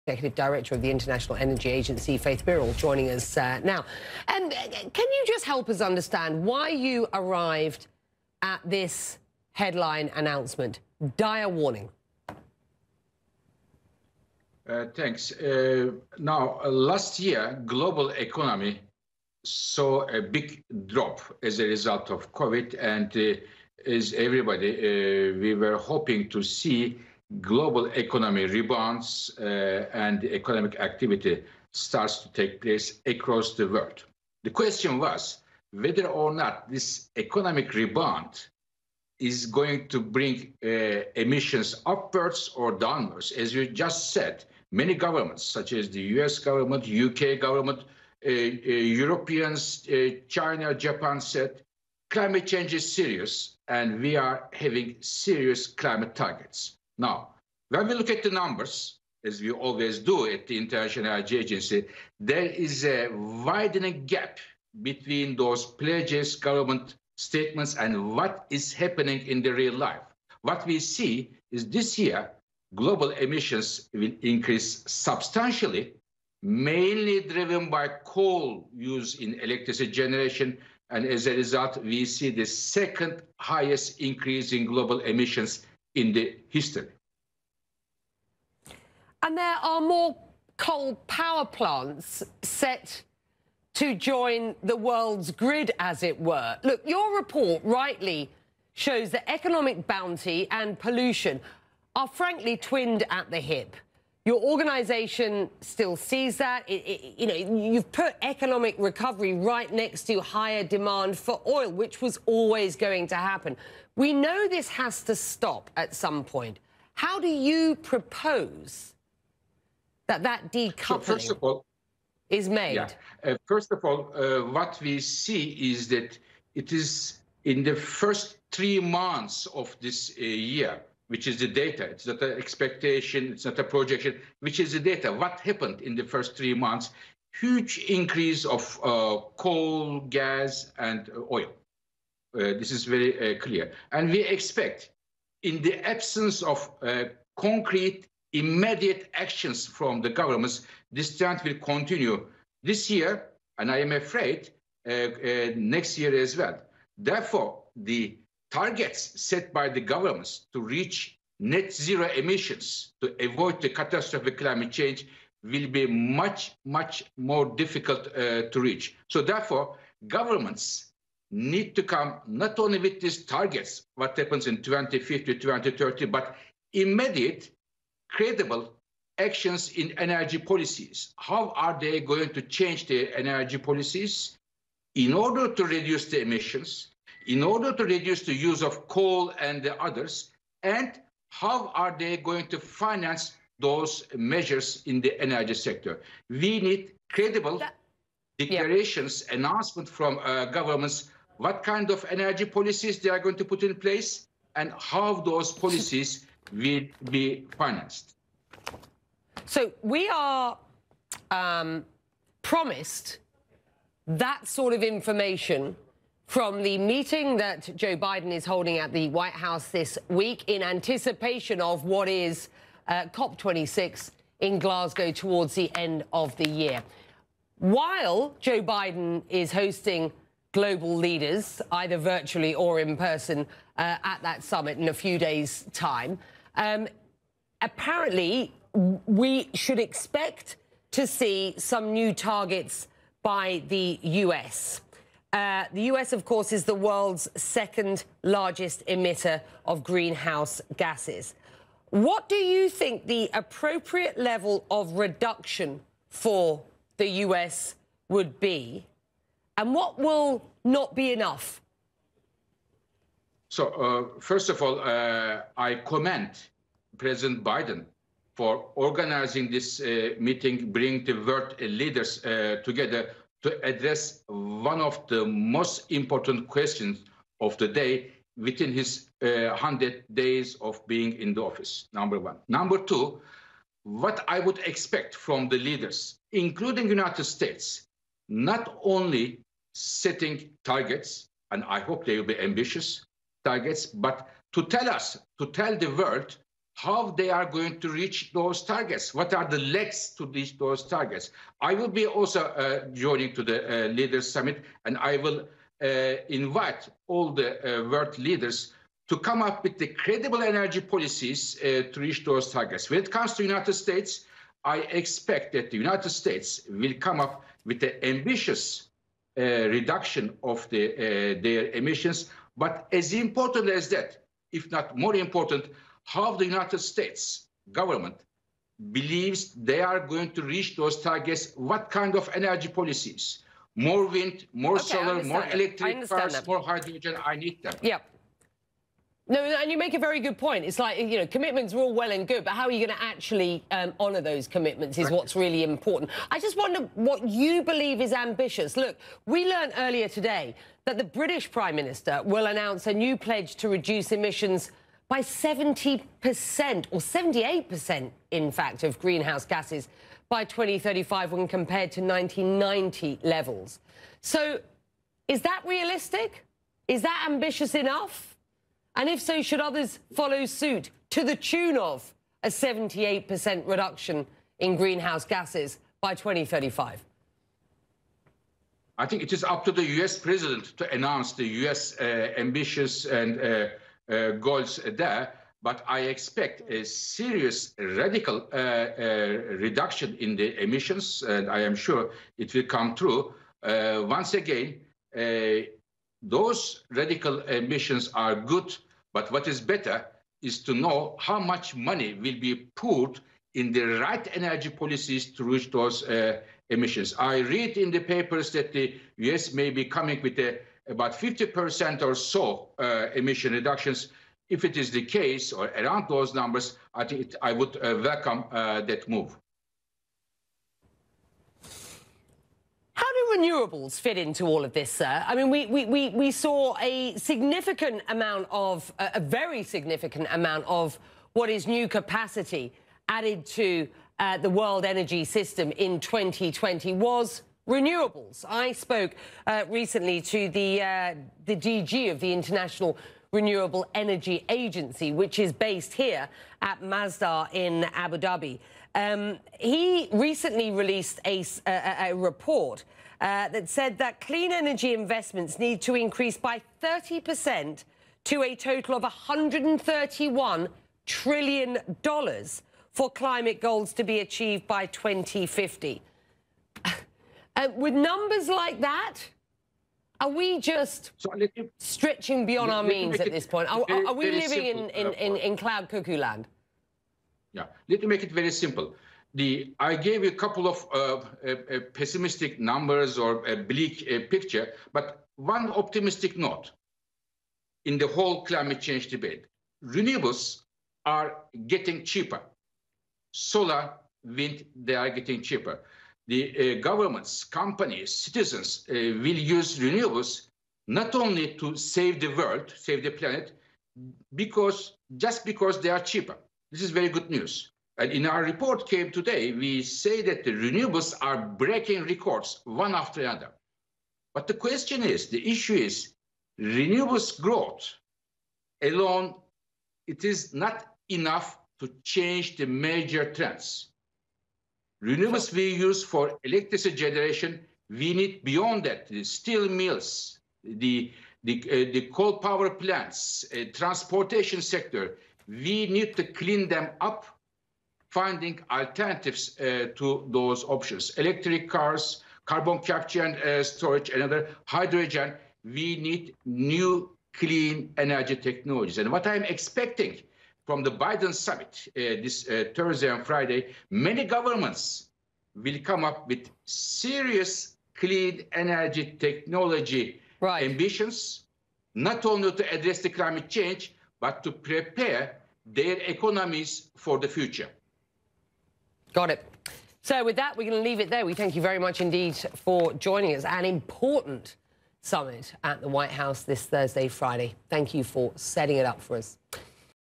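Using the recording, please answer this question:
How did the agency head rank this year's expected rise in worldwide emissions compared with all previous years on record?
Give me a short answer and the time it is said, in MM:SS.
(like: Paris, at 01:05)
Second highest, at 01:22.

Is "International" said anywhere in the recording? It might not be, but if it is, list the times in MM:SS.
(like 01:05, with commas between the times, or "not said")
00:00, 01:00, 07:22.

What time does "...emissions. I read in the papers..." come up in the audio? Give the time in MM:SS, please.
06:46.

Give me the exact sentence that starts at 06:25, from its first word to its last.
But I expect a serious radical uh, uh, reduction in the emissions, and I am sure it will come true.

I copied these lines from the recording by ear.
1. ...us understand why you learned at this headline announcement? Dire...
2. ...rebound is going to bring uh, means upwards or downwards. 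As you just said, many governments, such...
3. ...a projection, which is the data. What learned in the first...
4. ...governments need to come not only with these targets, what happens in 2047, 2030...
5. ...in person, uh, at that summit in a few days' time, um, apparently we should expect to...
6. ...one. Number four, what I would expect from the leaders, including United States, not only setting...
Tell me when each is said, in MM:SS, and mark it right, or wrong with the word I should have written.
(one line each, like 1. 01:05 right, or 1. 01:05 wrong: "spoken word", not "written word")
1. 00:05 wrong: "arrived", not "learned"
2. 00:37 wrong: "emissions", not "means"
3. 02:13 wrong: "happened", not "learned"
4. 02:50 wrong: "2050", not "2047"
5. 03:52 right
6. 04:42 wrong: "two", not "four".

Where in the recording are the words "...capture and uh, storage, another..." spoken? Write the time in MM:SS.
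09:02.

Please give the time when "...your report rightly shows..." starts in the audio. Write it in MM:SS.
01:36.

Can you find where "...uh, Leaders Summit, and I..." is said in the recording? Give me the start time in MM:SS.
05:03.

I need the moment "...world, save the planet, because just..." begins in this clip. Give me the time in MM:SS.
08:22.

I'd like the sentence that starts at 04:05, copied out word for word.
Uh, the US, of course, is the world's second largest emitter of greenhouse gases.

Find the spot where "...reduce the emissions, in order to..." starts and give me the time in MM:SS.
03:05.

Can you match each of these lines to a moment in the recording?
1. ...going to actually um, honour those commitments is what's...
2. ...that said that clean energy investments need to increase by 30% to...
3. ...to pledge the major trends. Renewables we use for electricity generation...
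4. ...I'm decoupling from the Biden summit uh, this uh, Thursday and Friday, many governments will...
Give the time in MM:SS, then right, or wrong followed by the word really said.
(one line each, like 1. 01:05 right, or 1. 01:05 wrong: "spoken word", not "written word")
1. 05:42 right
2. 07:33 right
3. 08:41 wrong: "change", not "pledge"
4. 09:09 wrong: "expecting", not "decoupling".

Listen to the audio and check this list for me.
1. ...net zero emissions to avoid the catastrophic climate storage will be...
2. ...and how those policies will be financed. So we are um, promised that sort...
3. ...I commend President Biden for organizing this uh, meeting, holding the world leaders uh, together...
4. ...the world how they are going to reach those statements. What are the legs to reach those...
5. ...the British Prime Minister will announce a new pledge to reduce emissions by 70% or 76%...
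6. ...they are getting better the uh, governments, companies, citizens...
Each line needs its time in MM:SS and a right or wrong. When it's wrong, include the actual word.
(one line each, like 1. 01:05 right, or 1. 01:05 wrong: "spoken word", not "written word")
1. 02:41 wrong: "change", not "storage"
2. 03:24 right
3. 04:25 wrong: "bringing", not "holding"
4. 04:55 wrong: "targets", not "statements"
5. 05:50 wrong: "78", not "76"
6. 08:14 wrong: "cheaper", not "better".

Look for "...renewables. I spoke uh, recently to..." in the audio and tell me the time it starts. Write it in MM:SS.
07:17.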